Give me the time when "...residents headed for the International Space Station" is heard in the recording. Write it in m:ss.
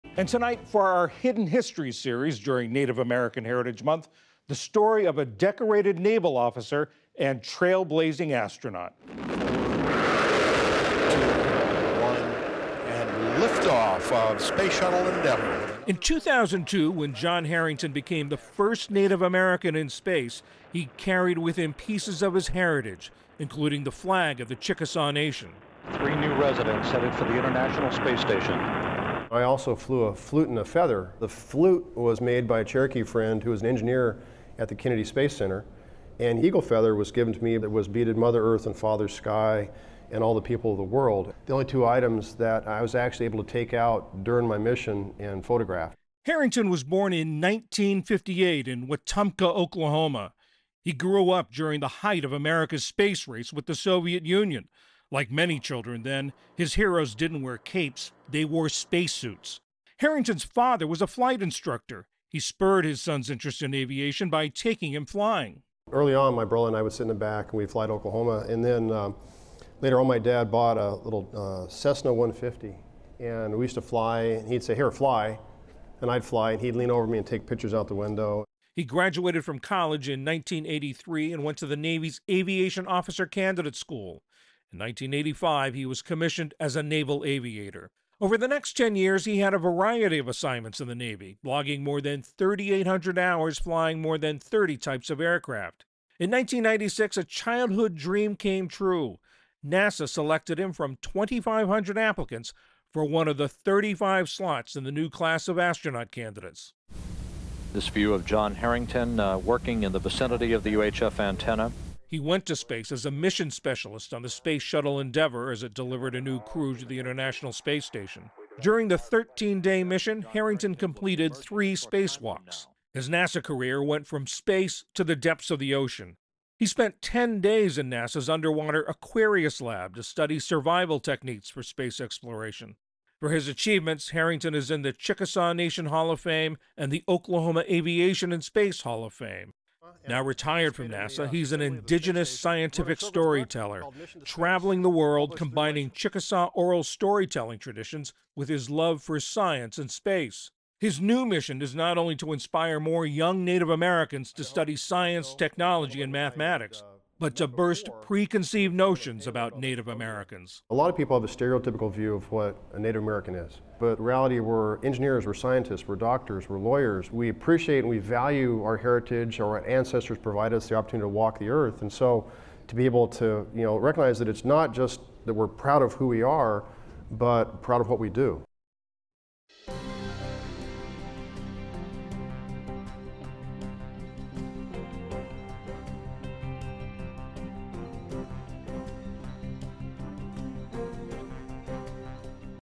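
0:26.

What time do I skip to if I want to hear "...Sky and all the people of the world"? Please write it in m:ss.
0:39.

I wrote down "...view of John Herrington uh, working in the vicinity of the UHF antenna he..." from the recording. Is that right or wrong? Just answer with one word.
right.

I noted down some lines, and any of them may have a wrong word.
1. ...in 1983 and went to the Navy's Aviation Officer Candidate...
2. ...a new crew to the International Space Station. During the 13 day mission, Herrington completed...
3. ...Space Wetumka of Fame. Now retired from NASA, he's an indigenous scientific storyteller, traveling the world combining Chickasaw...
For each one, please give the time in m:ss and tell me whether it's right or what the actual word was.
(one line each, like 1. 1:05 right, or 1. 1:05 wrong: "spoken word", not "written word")
1. 1:20 right
2. 1:56 right
3. 2:18 wrong: "Hall", not "Wetumka".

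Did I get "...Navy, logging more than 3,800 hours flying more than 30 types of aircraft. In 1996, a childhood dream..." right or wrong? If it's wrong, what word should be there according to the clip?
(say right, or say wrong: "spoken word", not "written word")
right.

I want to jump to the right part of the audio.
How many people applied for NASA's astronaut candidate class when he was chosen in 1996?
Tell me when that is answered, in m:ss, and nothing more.
1:41.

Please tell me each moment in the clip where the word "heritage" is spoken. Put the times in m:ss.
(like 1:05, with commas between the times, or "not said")
0:03, 0:22, 2:48.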